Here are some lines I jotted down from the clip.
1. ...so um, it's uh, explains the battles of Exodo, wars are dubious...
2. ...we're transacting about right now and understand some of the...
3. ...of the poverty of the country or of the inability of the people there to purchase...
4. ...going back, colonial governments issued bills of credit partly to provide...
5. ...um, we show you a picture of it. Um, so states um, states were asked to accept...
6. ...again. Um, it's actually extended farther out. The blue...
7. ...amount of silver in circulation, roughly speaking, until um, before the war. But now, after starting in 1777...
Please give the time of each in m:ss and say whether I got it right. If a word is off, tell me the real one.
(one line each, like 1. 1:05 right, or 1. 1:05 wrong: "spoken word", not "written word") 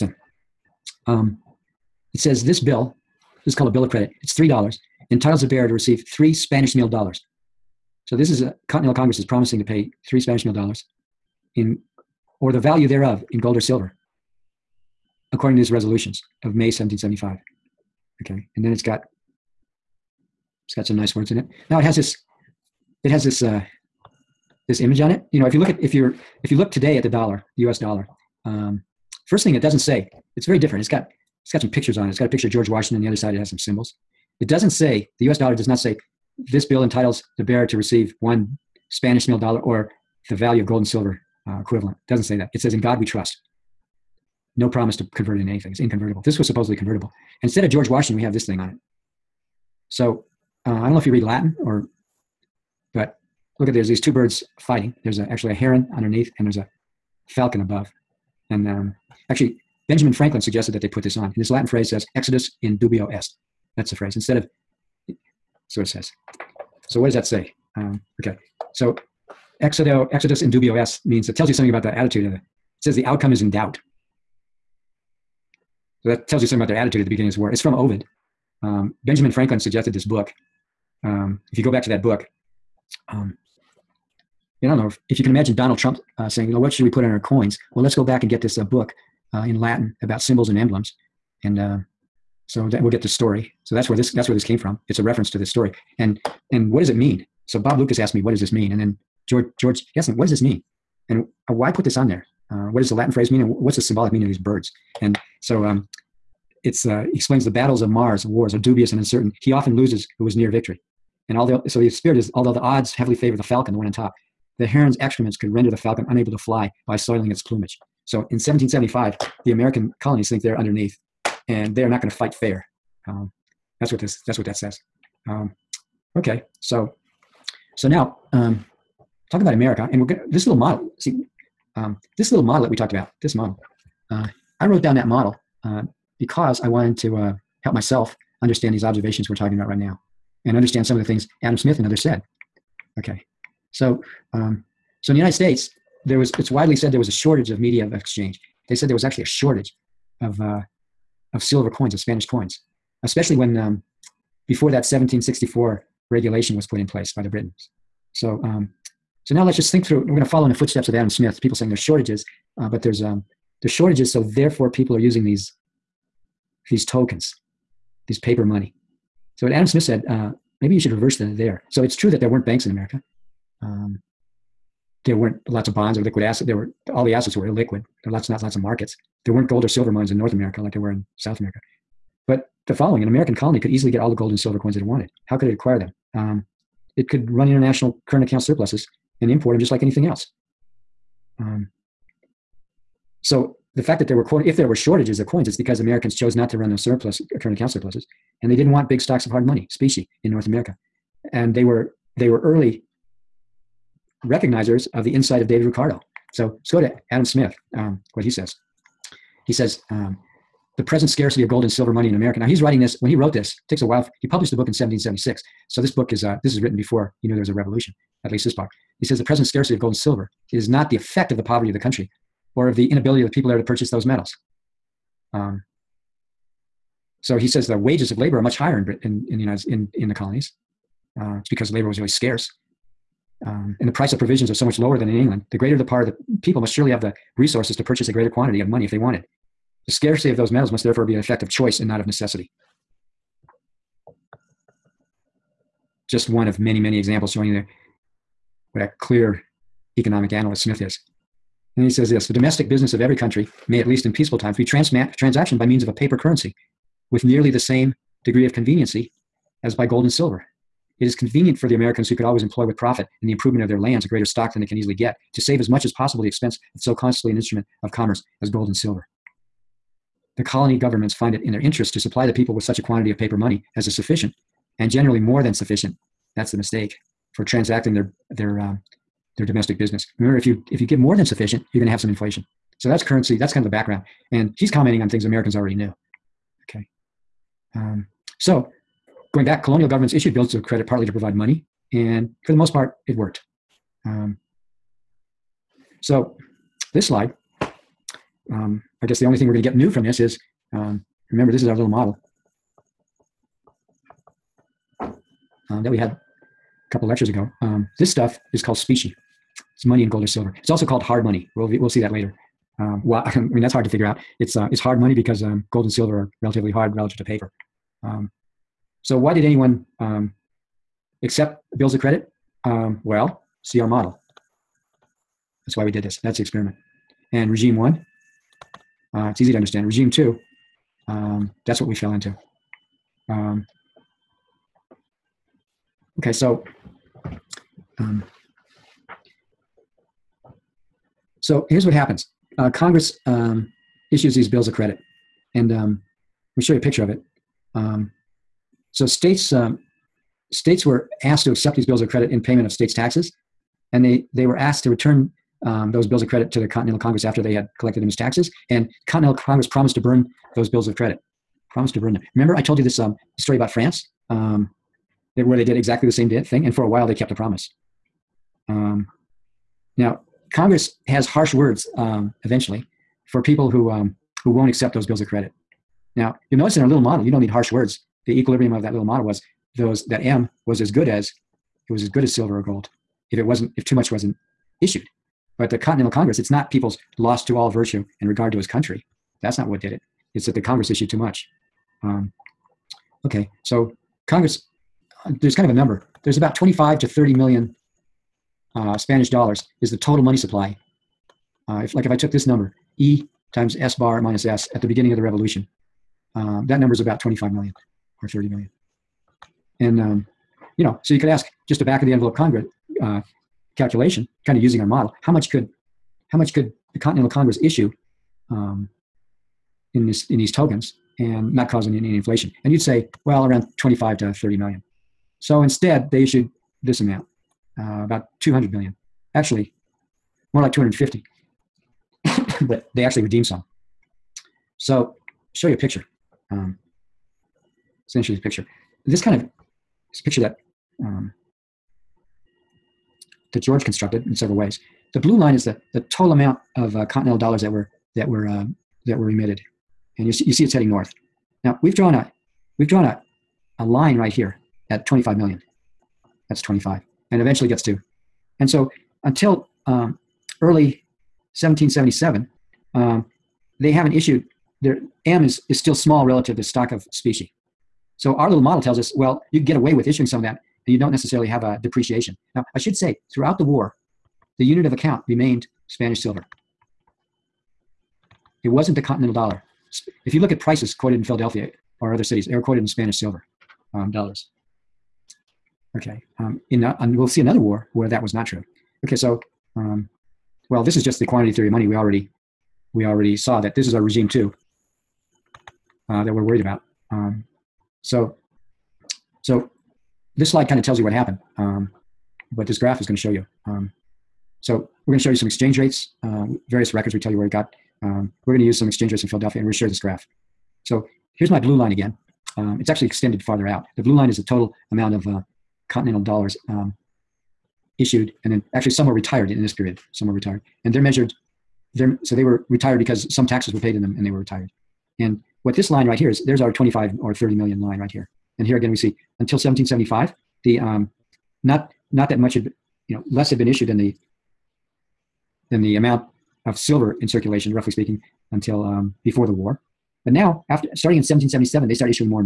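1. 1:45 wrong: "Mars", not "Exodo"
2. 2:19 wrong: "talking", not "transacting"
3. 3:41 right
4. 4:49 right
5. 5:45 right
6. 8:31 right
7. 8:55 right.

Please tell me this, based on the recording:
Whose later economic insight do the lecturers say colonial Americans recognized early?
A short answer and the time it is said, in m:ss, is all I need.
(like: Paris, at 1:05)
David Ricardo, at 3:25.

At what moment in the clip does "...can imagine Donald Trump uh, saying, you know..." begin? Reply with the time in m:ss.
1:25.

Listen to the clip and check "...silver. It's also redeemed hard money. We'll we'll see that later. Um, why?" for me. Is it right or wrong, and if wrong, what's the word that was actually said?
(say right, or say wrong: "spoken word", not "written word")
wrong: "called", not "redeemed".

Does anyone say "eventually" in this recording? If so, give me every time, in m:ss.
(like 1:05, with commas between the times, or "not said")
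6:12, 7:37.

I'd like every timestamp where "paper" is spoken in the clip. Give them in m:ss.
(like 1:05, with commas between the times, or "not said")
2:48, 4:15, 4:33, 5:17.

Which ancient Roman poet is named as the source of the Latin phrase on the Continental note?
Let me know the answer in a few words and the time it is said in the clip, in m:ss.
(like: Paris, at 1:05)
Ovid, at 1:17.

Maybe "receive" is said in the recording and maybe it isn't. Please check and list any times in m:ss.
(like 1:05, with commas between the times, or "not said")
0:05, 0:37.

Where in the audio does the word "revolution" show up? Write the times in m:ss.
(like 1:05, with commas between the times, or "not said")
3:37, 6:45.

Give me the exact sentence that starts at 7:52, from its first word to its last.
Now, I should say, throughout the war, the unit of account remained Spanish silver.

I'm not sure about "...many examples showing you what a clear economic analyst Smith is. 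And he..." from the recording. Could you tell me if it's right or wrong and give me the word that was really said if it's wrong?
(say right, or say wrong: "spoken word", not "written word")
right.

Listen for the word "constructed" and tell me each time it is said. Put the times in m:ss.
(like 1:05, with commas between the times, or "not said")
7:23.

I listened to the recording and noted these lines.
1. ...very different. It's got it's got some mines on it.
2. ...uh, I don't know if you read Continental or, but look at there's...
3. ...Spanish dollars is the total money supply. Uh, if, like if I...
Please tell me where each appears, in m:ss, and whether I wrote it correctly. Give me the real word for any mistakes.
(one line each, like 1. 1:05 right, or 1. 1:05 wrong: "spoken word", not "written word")
1. 0:30 wrong: "pictures", not "mines"
2. 0:50 wrong: "Latin", not "Continental"
3. 6:38 right.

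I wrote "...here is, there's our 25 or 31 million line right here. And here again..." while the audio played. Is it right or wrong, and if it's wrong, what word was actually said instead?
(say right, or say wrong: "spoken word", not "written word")
wrong: "30", not "31".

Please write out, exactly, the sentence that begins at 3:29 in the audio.
He says, um, the present scarcity of gold and silver money in America.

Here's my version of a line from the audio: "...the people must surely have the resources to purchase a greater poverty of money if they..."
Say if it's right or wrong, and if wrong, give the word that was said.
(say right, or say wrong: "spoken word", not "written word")
wrong: "quantity", not "poverty".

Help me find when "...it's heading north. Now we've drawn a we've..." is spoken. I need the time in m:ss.
7:30.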